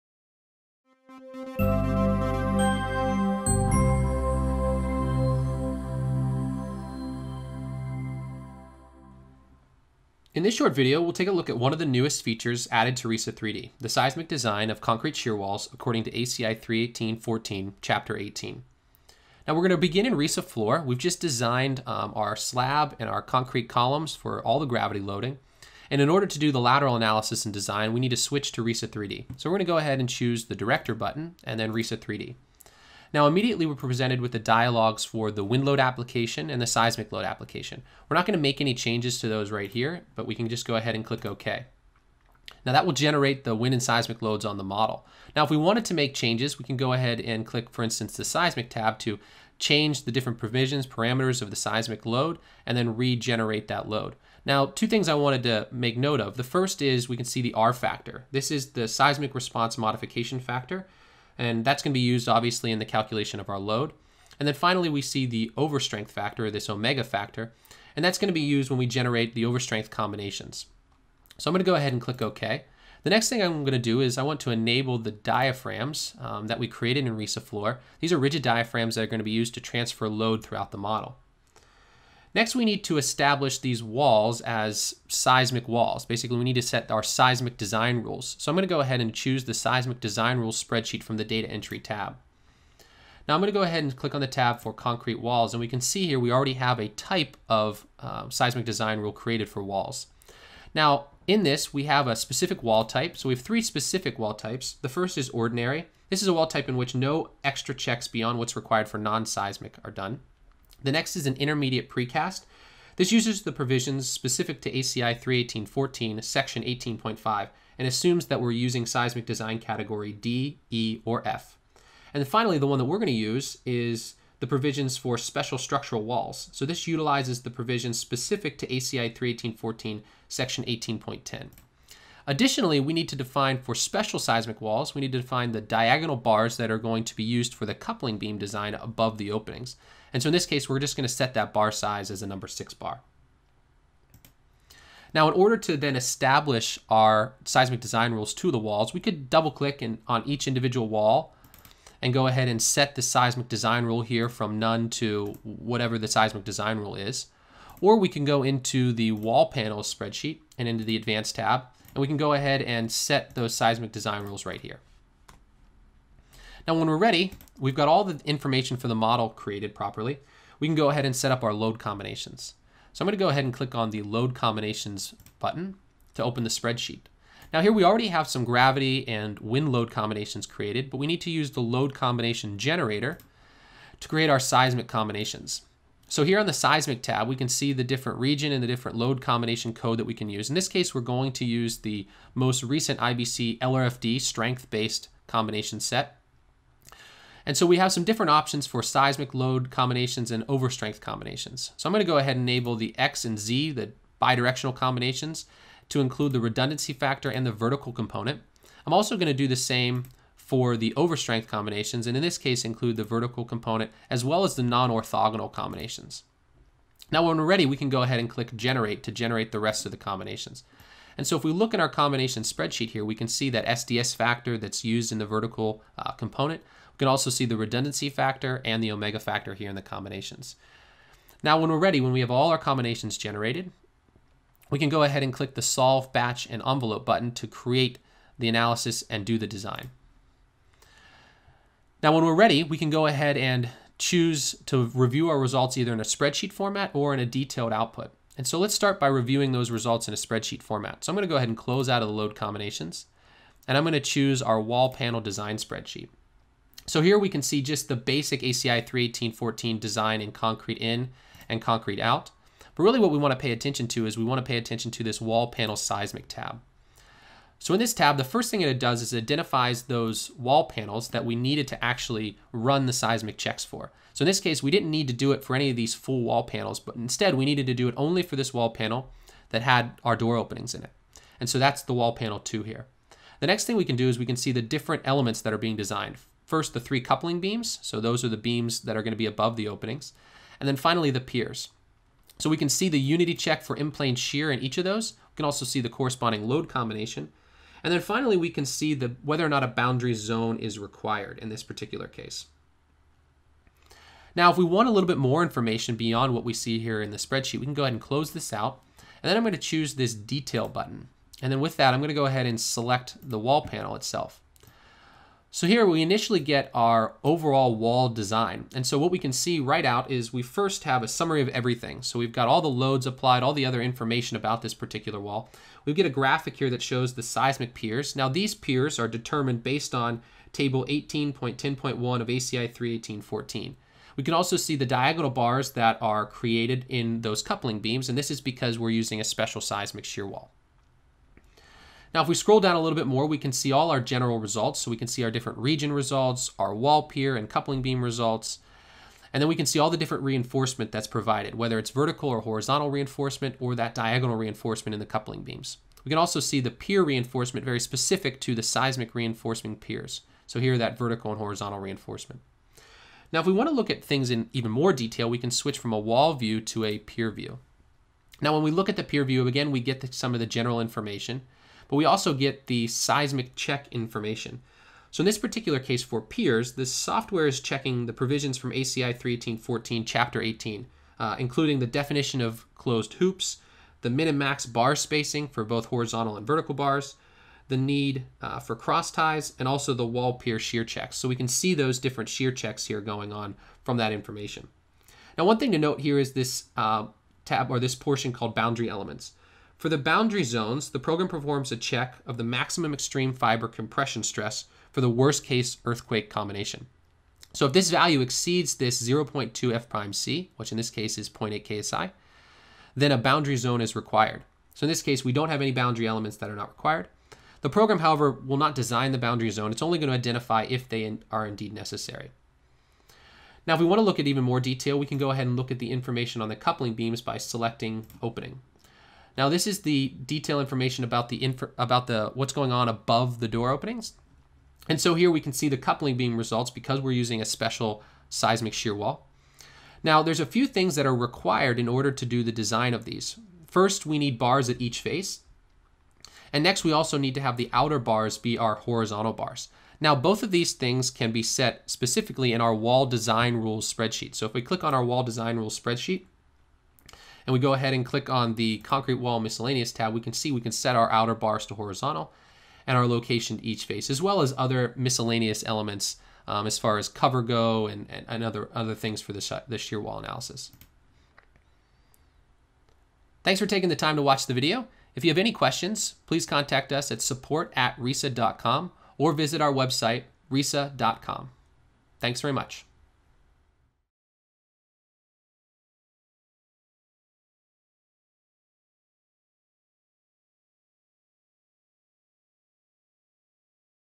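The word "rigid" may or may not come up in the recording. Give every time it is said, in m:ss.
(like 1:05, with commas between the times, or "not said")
1:18.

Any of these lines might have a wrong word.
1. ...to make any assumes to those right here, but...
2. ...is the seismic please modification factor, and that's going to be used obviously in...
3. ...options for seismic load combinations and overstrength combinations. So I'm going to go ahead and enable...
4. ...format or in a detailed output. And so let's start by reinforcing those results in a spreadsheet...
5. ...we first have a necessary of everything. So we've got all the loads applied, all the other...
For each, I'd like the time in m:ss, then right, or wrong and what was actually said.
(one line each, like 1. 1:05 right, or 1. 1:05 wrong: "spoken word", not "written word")
1. 0:38 wrong: "changes", not "assumes"
2. 0:58 wrong: "response", not "please"
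3. 3:18 right
4. 4:06 wrong: "reviewing", not "reinforcing"
5. 5:20 wrong: "summary", not "necessary".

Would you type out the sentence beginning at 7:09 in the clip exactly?
Now this is the detail information about the inf- about the what's going on above the door openings.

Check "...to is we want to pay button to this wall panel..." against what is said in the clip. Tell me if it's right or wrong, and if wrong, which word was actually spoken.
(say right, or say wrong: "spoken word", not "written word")
wrong: "attention", not "button".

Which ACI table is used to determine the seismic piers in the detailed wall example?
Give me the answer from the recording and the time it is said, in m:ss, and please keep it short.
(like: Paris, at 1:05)
Table 18.10.1, at 5:30.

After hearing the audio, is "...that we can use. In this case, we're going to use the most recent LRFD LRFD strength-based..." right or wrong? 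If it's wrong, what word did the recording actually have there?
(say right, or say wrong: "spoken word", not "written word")
wrong: "IBC", not "LRFD".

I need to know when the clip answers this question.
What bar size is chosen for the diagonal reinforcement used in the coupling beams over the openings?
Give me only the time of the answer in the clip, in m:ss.
2:22.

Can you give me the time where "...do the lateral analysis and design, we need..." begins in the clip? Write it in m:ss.
0:26.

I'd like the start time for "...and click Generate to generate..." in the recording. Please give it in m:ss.
3:38.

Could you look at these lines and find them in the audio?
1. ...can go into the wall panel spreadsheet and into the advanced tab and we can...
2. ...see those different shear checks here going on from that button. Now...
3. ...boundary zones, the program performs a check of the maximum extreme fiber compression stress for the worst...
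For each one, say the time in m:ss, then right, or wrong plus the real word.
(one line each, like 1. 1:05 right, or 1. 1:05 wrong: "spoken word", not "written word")
1. 2:38 right
2. 6:31 wrong: "information", not "button"
3. 6:39 right.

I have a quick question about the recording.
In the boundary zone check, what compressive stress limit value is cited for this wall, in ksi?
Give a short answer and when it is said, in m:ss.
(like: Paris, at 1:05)
0.8 ksi, at 6:51.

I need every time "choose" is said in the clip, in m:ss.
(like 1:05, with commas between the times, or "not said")
0:30, 1:29, 4:03, 4:13, 5:09.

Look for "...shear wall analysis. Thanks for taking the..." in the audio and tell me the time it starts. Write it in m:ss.
7:49.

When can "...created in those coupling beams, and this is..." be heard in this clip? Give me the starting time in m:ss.
5:36.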